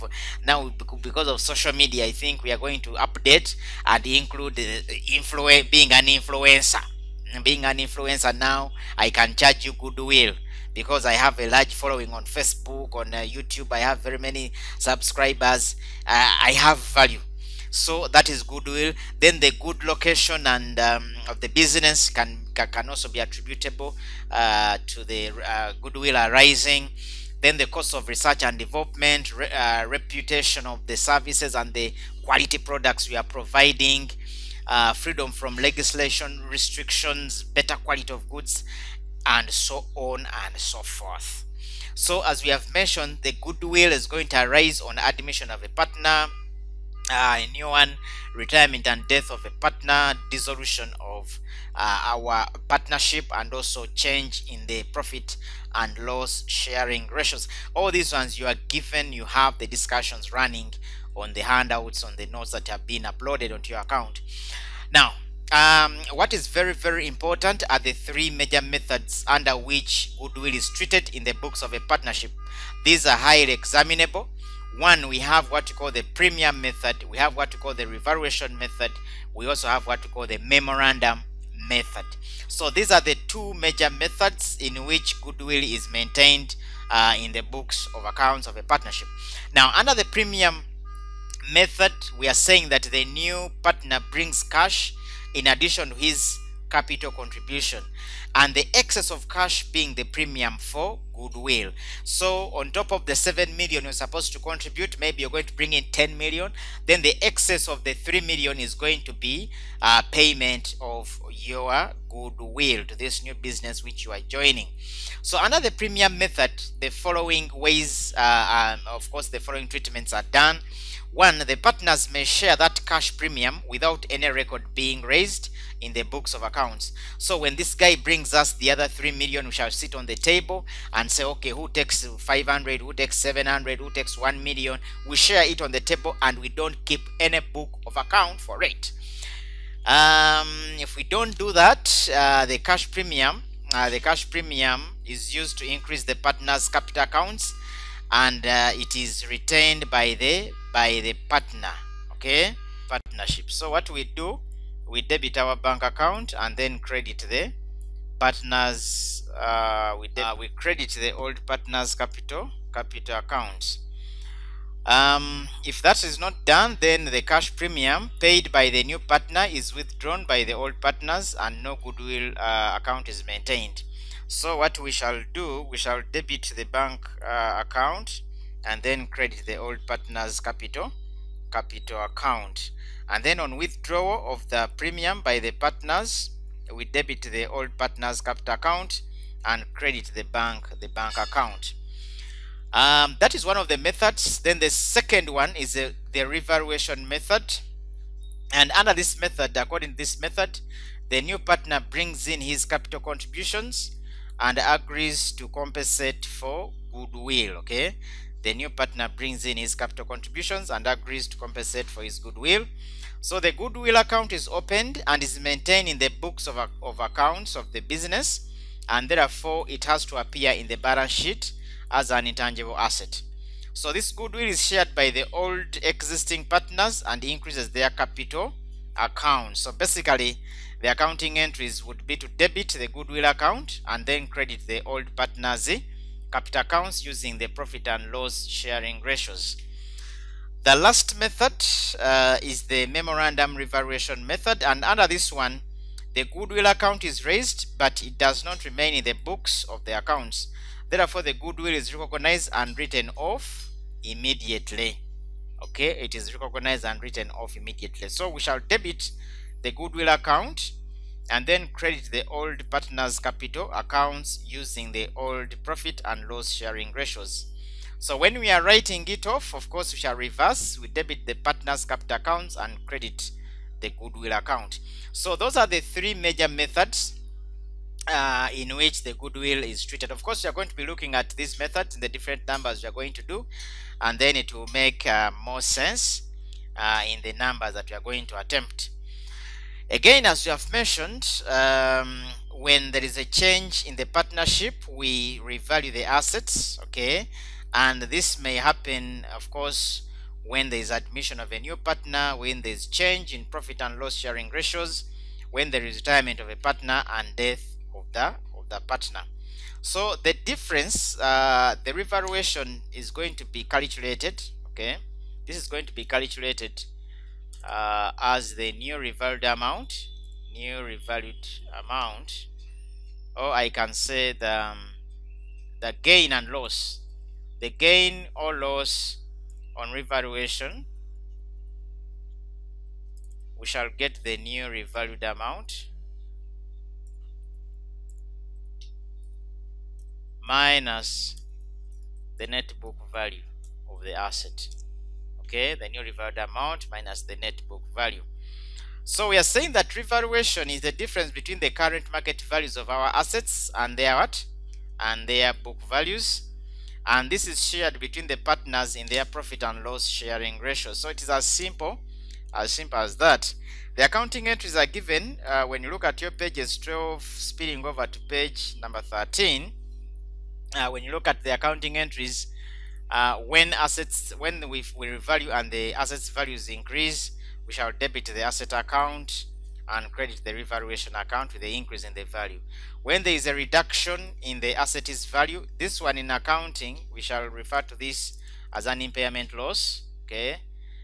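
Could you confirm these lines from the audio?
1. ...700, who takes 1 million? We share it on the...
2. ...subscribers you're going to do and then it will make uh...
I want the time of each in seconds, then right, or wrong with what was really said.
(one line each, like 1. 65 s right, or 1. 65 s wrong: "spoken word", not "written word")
1. 133 s right
2. 282 s wrong: "numbers", not "subscribers".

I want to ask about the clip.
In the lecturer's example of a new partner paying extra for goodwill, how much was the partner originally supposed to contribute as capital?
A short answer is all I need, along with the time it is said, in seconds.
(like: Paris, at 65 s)
7 million, at 103 s.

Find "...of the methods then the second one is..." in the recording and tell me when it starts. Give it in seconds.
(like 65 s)
193 s.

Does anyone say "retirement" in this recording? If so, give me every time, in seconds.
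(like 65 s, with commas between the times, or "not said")
48 s, 305 s.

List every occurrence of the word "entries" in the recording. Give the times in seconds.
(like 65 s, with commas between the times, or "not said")
231 s, 364 s, 371 s.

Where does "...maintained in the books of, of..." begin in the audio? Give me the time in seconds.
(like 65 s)
215 s.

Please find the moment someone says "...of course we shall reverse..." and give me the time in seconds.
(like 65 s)
269 s.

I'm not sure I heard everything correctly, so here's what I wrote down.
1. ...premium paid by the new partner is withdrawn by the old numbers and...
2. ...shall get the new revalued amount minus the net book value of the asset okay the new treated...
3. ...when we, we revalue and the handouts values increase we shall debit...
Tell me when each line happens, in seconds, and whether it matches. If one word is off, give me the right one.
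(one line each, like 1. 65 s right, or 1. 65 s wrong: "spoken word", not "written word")
1. 167 s wrong: "partners", not "numbers"
2. 333 s wrong: "revalued", not "treated"
3. 374 s wrong: "assets", not "handouts".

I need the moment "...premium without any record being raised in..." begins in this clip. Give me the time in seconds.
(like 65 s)
123 s.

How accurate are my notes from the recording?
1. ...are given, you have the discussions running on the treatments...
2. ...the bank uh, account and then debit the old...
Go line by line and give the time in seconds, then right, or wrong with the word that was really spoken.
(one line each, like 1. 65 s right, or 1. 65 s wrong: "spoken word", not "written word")
1. 58 s wrong: "handouts", not "treatments"
2. 176 s wrong: "credit", not "debit".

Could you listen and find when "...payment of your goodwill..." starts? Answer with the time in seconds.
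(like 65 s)
110 s.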